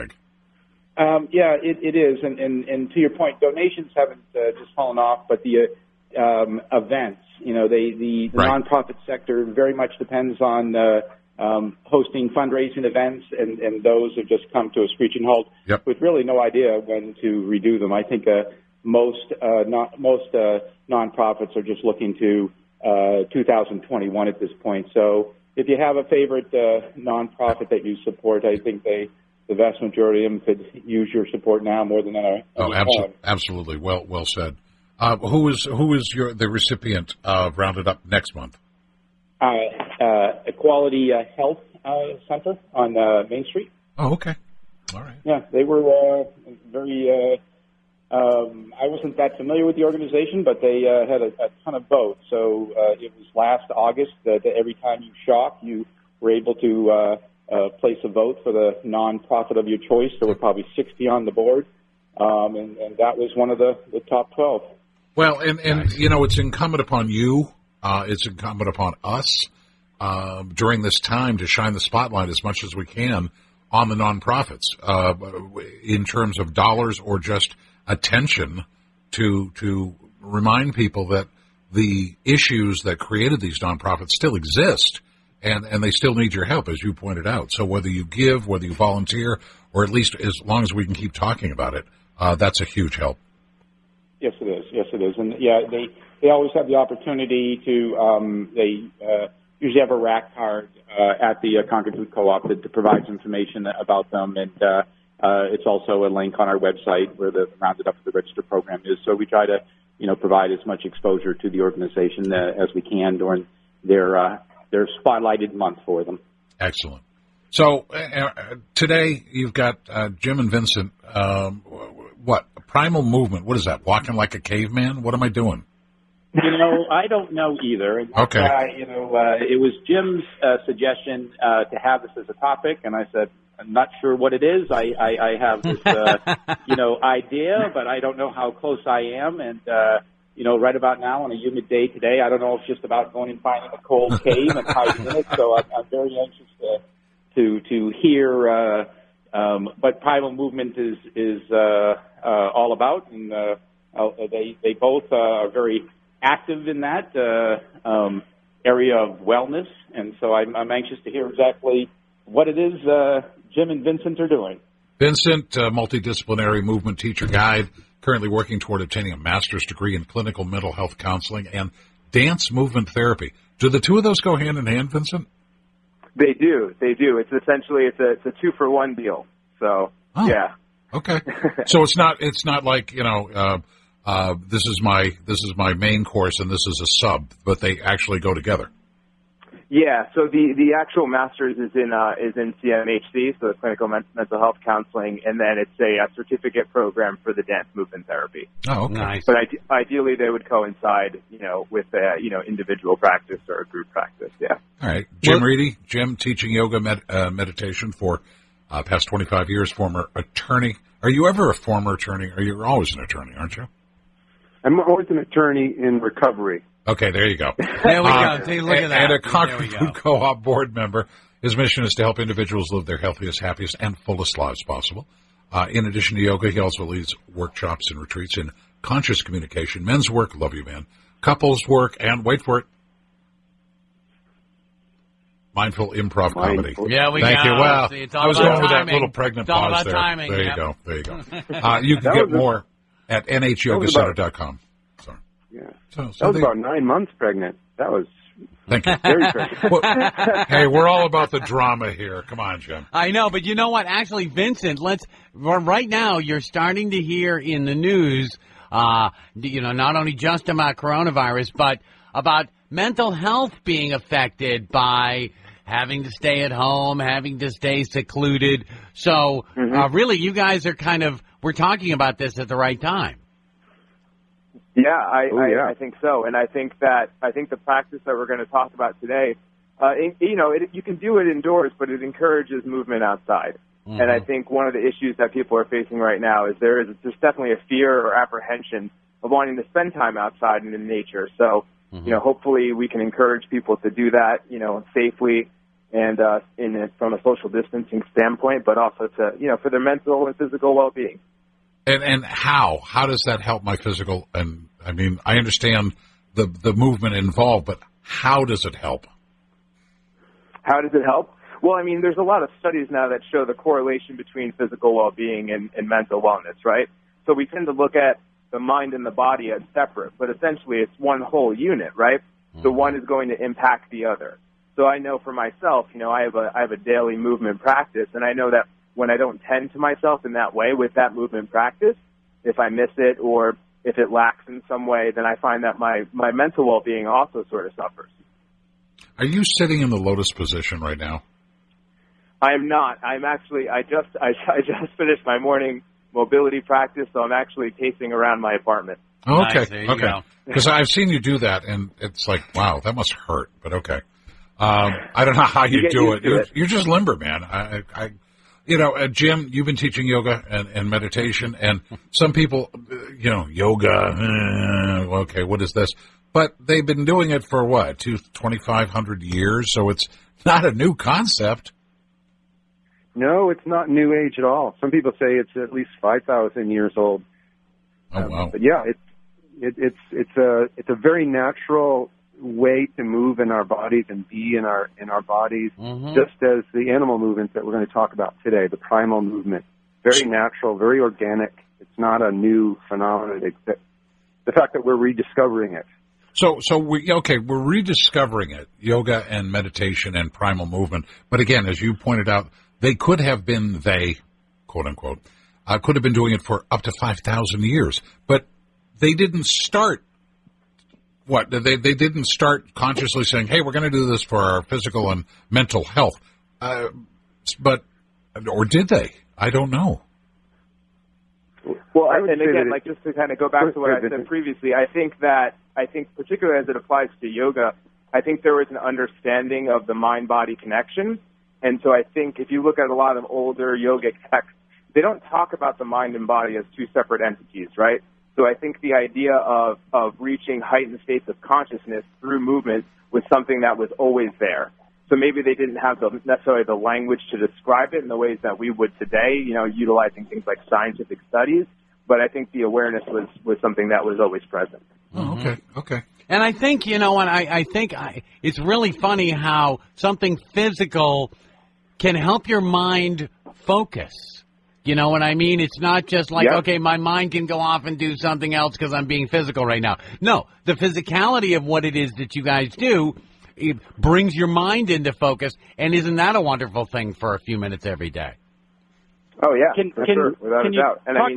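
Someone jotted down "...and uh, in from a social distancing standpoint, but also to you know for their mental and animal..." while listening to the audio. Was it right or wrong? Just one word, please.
wrong.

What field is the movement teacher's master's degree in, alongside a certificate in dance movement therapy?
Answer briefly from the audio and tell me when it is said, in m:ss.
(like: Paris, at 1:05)
clinical mental health counseling, at 2:50.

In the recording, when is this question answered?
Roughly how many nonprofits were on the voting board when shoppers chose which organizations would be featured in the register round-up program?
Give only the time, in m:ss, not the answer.
1:00.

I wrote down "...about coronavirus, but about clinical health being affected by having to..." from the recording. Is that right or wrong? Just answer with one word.
wrong.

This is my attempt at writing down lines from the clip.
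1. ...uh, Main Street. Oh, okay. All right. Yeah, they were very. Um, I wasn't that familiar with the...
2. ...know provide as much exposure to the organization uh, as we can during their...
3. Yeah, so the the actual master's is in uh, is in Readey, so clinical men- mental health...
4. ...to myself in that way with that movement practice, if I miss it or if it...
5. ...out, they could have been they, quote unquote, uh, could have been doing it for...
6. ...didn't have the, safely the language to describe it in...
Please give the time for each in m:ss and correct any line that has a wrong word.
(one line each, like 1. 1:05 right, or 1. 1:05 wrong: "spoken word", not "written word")
1. 0:42 right
2. 1:50 right
3. 3:09 wrong: "CMHC", not "Readey"
4. 5:29 right
5. 6:42 right
6. 7:25 wrong: "necessarily", not "safely".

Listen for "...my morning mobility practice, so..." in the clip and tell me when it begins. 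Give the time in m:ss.
5:45.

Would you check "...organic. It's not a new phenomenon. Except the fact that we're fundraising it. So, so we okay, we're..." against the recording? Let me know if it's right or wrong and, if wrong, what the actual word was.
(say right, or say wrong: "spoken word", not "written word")
wrong: "rediscovering", not "fundraising".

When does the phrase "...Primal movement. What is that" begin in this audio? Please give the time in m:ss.
2:02.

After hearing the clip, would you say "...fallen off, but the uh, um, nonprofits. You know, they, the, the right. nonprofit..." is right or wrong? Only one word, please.
wrong.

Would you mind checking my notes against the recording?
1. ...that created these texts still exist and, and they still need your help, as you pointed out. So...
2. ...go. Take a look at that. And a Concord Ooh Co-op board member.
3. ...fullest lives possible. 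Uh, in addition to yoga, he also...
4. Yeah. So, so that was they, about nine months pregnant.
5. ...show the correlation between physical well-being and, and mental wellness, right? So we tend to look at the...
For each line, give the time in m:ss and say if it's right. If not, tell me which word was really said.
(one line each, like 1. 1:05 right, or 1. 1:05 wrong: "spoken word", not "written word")
1. 1:22 wrong: "nonprofits", not "texts"
2. 3:38 wrong: "Food", not "Ooh"
3. 3:43 right
4. 4:05 right
5. 5:13 right.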